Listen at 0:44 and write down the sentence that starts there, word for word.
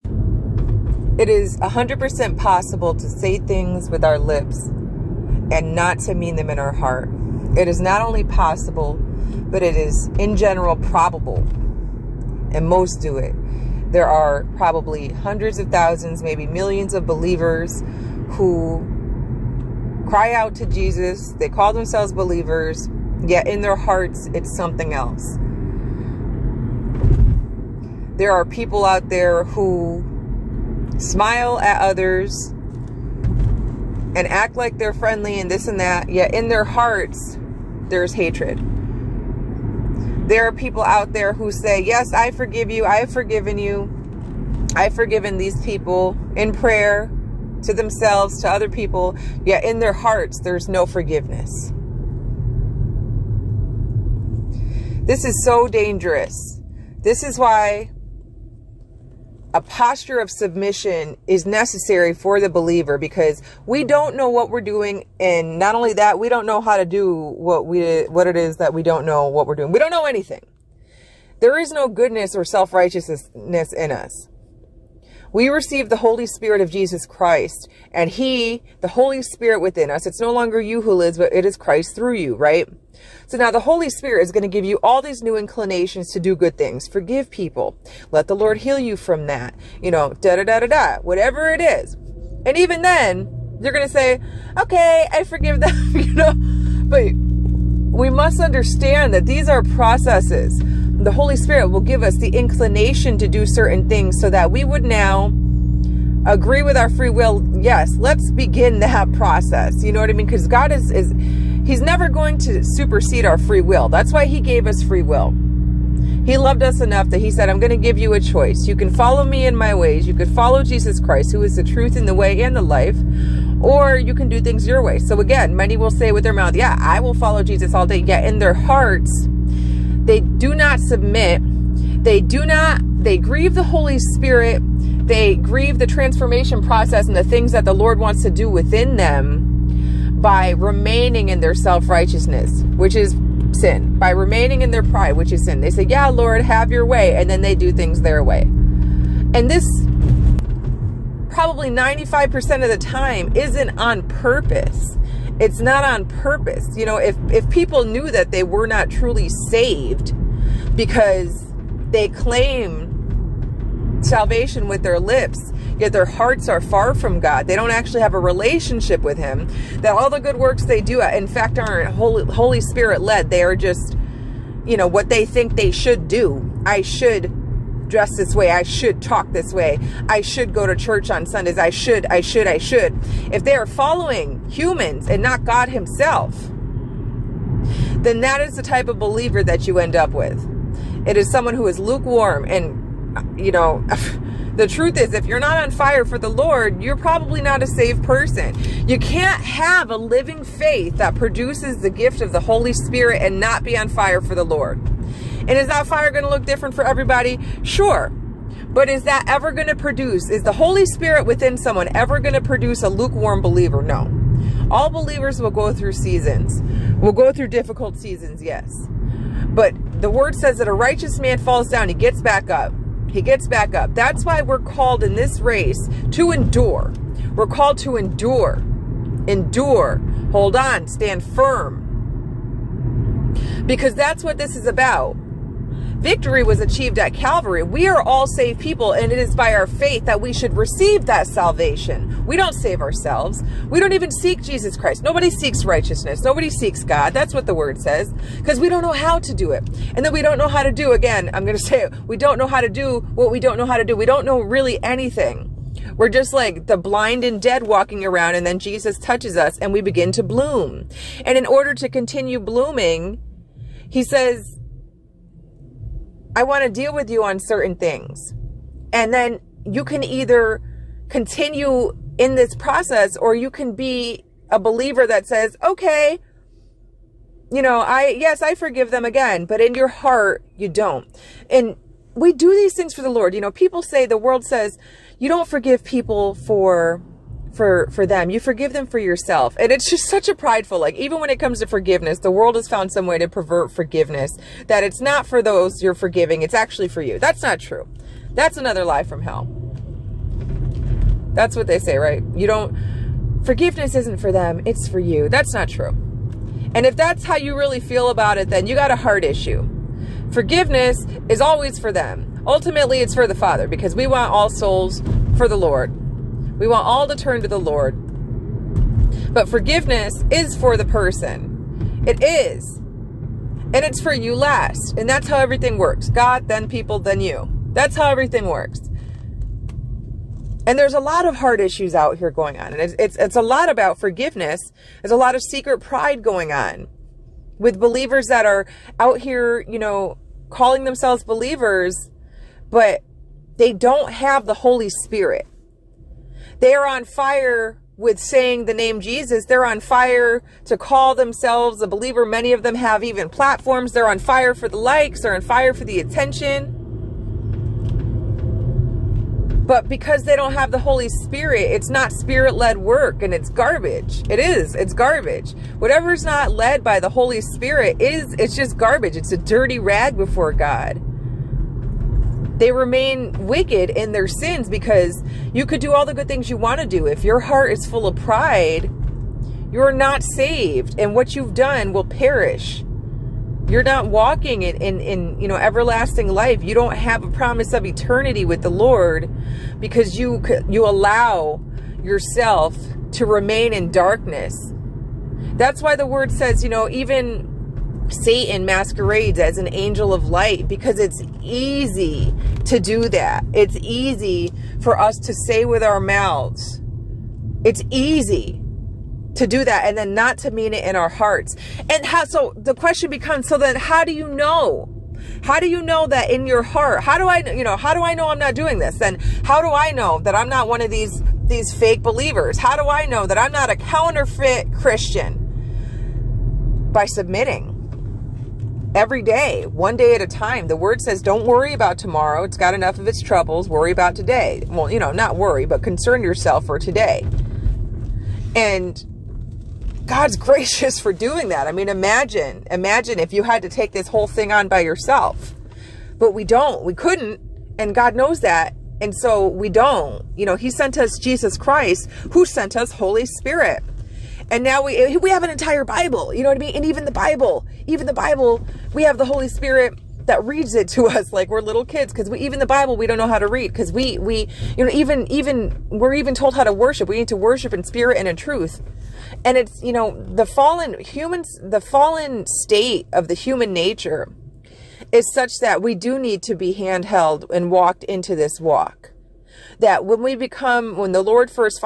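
I've forgiven these people in prayer to themselves, to other people, yet in their hearts, there's no forgiveness.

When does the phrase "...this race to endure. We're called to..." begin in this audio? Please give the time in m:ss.
3:45.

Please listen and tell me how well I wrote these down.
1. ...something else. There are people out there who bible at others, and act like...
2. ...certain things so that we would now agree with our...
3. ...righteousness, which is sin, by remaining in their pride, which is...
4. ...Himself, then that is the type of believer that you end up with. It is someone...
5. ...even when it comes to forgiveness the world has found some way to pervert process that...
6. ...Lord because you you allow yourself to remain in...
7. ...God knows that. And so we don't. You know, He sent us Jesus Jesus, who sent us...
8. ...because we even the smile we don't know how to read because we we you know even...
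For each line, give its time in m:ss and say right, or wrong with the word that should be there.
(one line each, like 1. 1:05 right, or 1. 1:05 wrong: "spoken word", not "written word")
1. 0:24 wrong: "smile", not "bible"
2. 1:43 right
3. 2:21 right
4. 3:05 right
5. 4:50 wrong: "forgiveness", not "process"
6. 6:28 right
7. 7:27 wrong: "Christ", not "Jesus"
8. 7:42 wrong: "bible", not "smile".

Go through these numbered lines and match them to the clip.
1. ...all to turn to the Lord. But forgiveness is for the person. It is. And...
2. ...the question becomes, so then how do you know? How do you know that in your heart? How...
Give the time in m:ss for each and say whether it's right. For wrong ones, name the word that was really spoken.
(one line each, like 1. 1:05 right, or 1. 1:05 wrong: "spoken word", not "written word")
1. 5:16 right
2. 6:52 right.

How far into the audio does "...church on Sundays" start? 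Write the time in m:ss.
3:00.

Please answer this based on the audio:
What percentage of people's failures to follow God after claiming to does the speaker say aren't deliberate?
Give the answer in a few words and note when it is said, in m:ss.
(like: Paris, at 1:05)
95%, at 2:31.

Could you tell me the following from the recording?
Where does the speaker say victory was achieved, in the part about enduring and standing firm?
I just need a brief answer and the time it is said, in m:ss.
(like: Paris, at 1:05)
Calvary, at 3:57.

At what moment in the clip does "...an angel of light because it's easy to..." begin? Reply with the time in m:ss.
6:39.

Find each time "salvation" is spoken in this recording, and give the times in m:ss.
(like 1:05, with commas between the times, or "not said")
2:44, 4:01.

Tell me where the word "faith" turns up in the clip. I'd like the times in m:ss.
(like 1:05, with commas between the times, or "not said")
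3:20, 3:59.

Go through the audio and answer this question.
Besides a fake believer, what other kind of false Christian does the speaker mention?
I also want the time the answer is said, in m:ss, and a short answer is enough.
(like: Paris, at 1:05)
Counterfeit, at 7:03.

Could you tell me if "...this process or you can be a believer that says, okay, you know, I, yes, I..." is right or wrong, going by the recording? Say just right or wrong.
right.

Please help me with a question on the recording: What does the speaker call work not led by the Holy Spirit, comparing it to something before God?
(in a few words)
A dirty rag.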